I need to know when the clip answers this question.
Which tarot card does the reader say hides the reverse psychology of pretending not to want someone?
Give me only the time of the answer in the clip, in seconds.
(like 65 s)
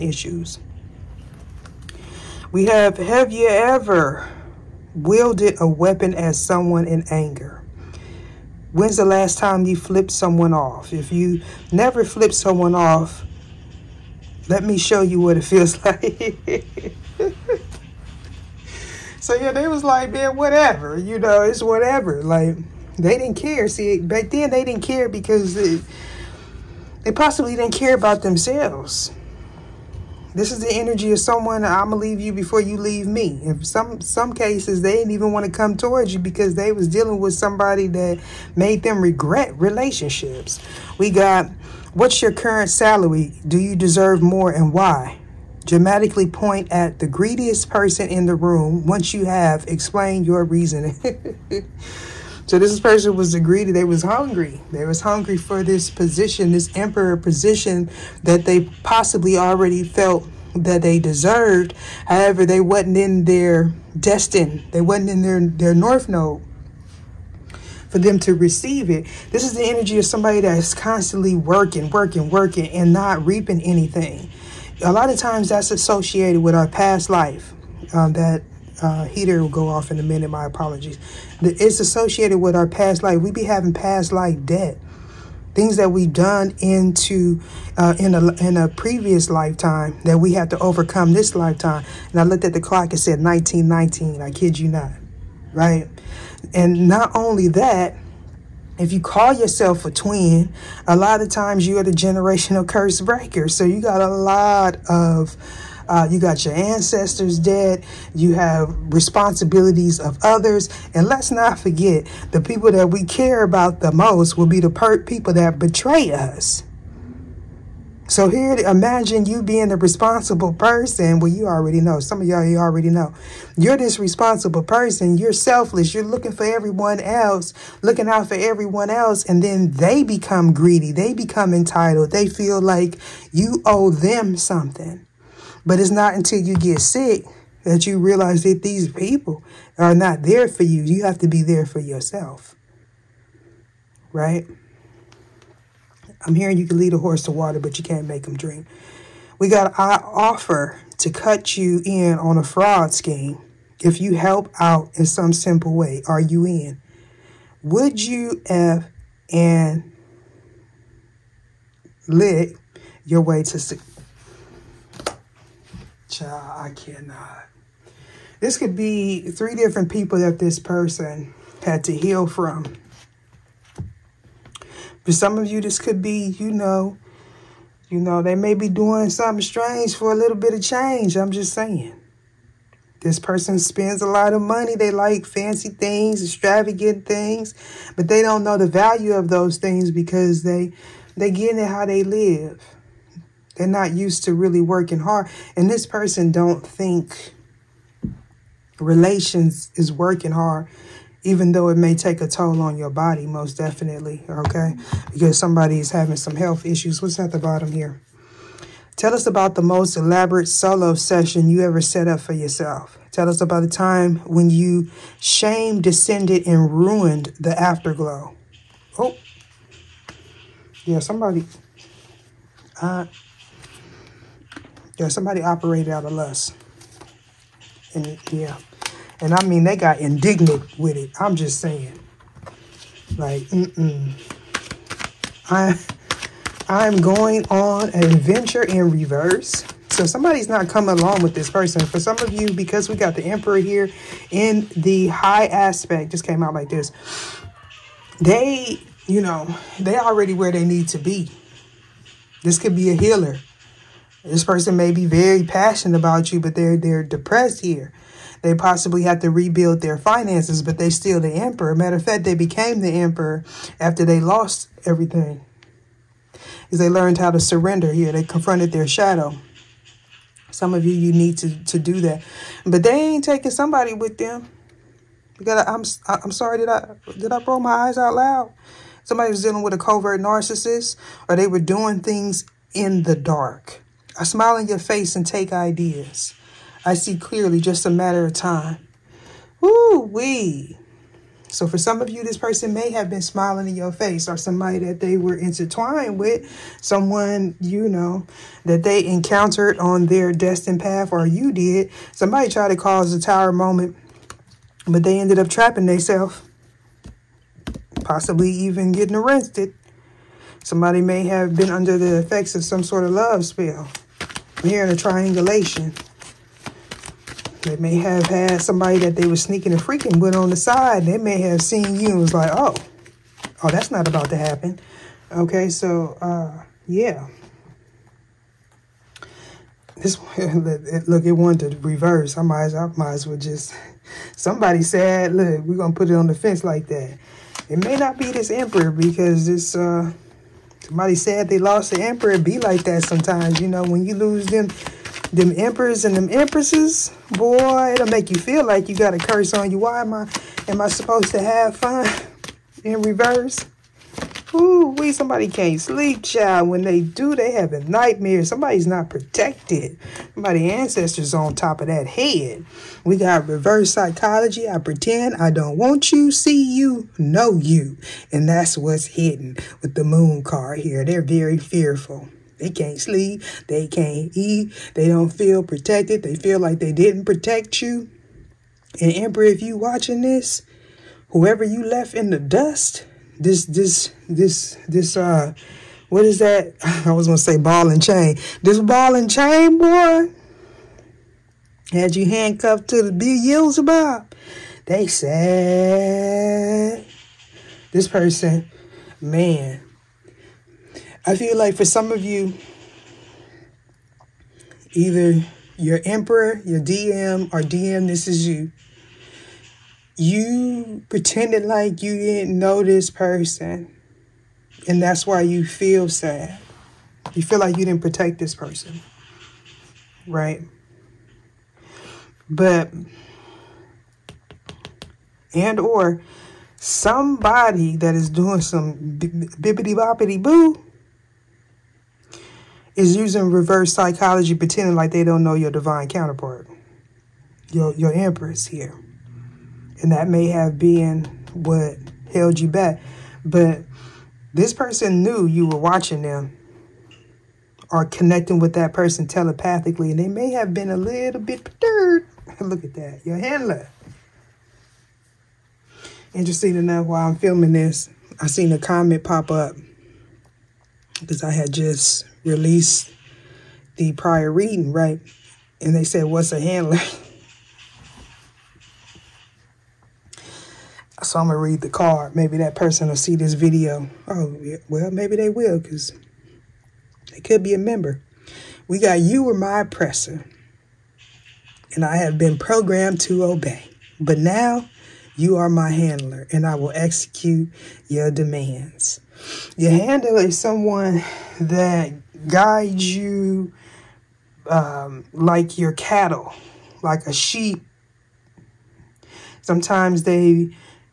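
370 s.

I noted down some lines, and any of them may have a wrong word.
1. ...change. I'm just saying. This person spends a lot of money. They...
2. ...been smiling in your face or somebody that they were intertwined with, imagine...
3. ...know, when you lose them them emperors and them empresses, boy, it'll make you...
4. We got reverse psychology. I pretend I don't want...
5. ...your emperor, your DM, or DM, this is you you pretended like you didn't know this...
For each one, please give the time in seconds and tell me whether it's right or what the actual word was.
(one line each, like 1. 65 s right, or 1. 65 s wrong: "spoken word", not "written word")
1. 180 s right
2. 293 s wrong: "someone", not "imagine"
3. 343 s right
4. 363 s right
5. 405 s right.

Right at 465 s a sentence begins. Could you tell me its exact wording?
And they said, What's a handler?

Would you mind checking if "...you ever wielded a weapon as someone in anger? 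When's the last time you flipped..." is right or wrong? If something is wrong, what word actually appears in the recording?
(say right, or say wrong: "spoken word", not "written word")
right.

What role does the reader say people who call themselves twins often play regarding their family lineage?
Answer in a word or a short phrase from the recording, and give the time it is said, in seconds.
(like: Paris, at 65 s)
generational curse breaker, at 101 s.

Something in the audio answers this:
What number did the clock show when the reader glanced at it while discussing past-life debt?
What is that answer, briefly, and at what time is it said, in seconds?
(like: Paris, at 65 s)
1919, at 93 s.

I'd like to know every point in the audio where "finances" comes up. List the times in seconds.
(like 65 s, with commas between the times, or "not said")
259 s.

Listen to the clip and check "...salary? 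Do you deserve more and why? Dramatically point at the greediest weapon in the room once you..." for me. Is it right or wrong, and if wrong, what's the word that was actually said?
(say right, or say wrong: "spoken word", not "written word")
wrong: "person", not "weapon".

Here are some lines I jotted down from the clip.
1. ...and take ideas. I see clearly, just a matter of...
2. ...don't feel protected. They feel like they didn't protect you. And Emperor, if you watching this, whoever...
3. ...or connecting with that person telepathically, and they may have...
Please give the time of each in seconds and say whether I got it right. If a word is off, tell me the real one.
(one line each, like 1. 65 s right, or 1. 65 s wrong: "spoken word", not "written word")
1. 285 s right
2. 375 s right
3. 447 s right.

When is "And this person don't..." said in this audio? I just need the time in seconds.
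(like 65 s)
195 s.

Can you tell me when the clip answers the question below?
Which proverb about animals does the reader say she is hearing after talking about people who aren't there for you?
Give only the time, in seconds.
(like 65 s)
146 s.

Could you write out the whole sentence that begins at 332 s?
I might, I might as well just, somebody said, look, we're going to put it on the fence like that.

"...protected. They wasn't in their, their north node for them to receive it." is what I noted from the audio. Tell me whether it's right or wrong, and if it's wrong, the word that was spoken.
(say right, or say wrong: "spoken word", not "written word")
wrong: "destined", not "protected".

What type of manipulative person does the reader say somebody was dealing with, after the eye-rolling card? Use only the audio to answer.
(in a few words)
a covert narcissist.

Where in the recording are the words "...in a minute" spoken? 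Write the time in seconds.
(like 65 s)
79 s.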